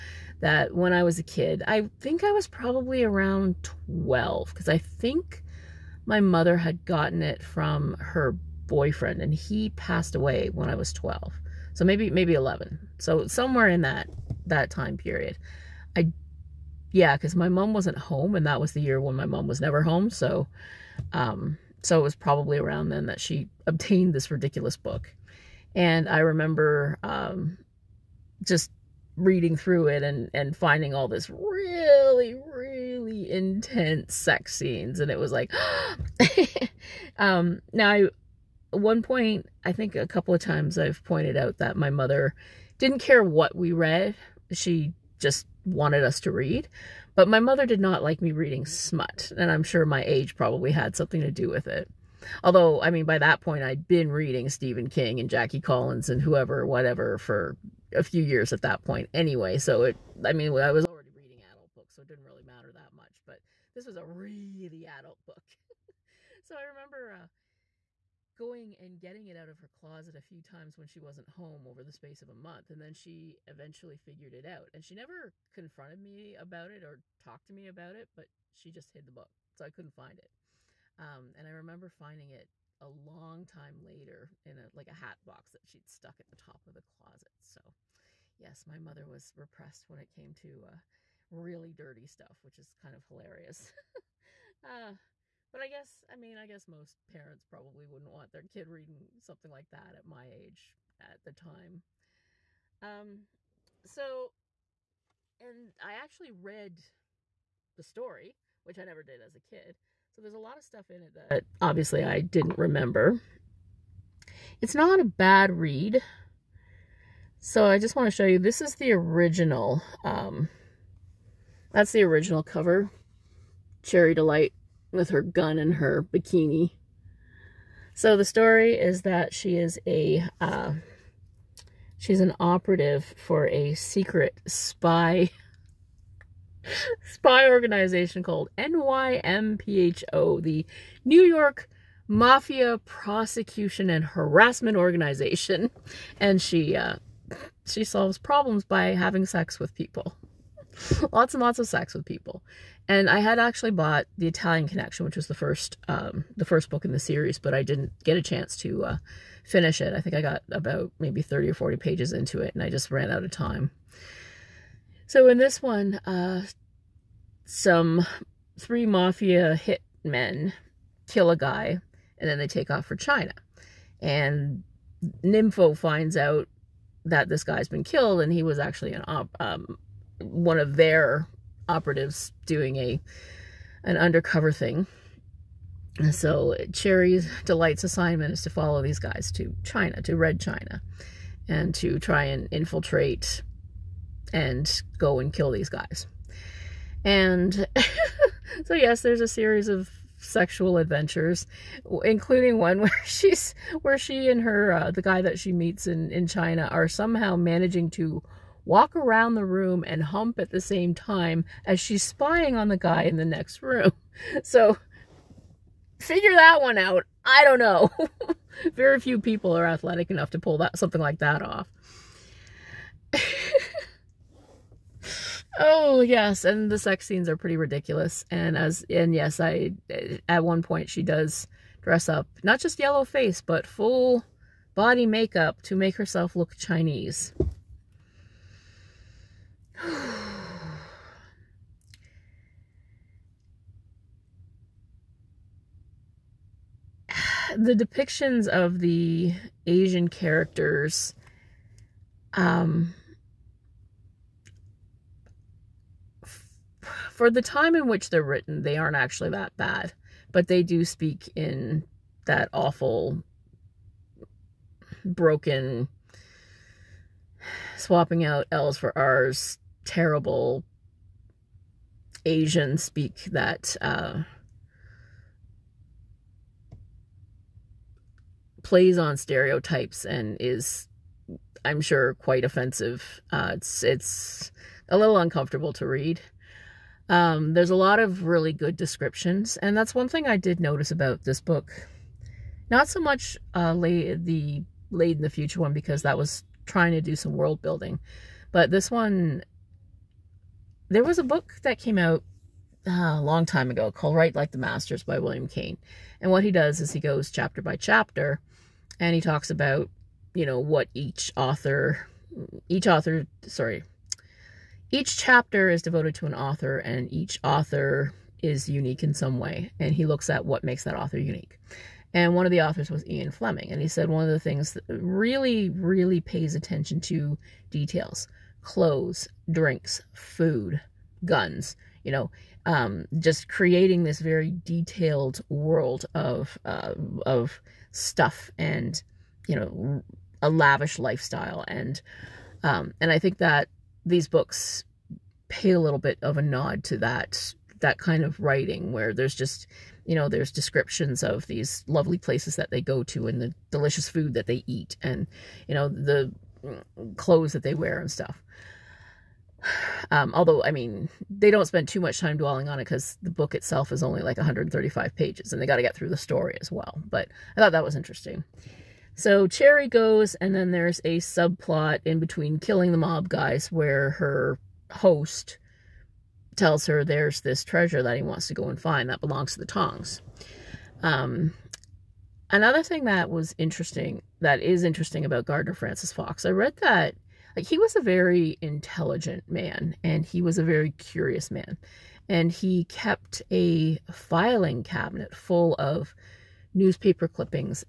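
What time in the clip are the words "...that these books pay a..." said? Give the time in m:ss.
5:43.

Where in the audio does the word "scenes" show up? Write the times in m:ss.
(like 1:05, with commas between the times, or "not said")
0:34, 3:47.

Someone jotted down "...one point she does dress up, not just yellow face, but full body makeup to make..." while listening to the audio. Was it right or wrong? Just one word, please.
right.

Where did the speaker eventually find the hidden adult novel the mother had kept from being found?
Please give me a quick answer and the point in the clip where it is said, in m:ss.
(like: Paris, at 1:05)
A hat box, at 1:24.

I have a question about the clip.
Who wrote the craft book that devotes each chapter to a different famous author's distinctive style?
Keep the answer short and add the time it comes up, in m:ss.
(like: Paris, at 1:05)
William Cane, at 5:05.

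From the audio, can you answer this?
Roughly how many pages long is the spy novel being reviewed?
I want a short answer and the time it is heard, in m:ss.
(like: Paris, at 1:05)
135, at 6:04.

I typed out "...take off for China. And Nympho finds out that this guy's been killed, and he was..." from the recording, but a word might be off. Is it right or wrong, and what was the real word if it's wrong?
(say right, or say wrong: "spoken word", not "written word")
right.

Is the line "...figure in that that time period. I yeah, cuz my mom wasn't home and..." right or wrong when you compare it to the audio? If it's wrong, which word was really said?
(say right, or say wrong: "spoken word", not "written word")
wrong: "somewhere", not "figure".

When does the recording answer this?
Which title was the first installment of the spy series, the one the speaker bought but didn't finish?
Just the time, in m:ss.
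2:34.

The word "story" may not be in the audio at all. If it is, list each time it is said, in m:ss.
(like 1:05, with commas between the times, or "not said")
1:47, 2:08, 6:06.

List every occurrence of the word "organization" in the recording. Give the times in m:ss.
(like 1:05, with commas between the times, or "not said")
2:17, 2:24.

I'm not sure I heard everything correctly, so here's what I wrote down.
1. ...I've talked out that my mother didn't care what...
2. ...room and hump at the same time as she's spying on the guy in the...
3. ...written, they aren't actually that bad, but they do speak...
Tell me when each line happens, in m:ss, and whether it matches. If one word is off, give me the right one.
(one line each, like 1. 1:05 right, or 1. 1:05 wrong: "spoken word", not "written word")
1. 0:40 wrong: "pointed", not "talked"
2. 3:29 right
3. 4:18 right.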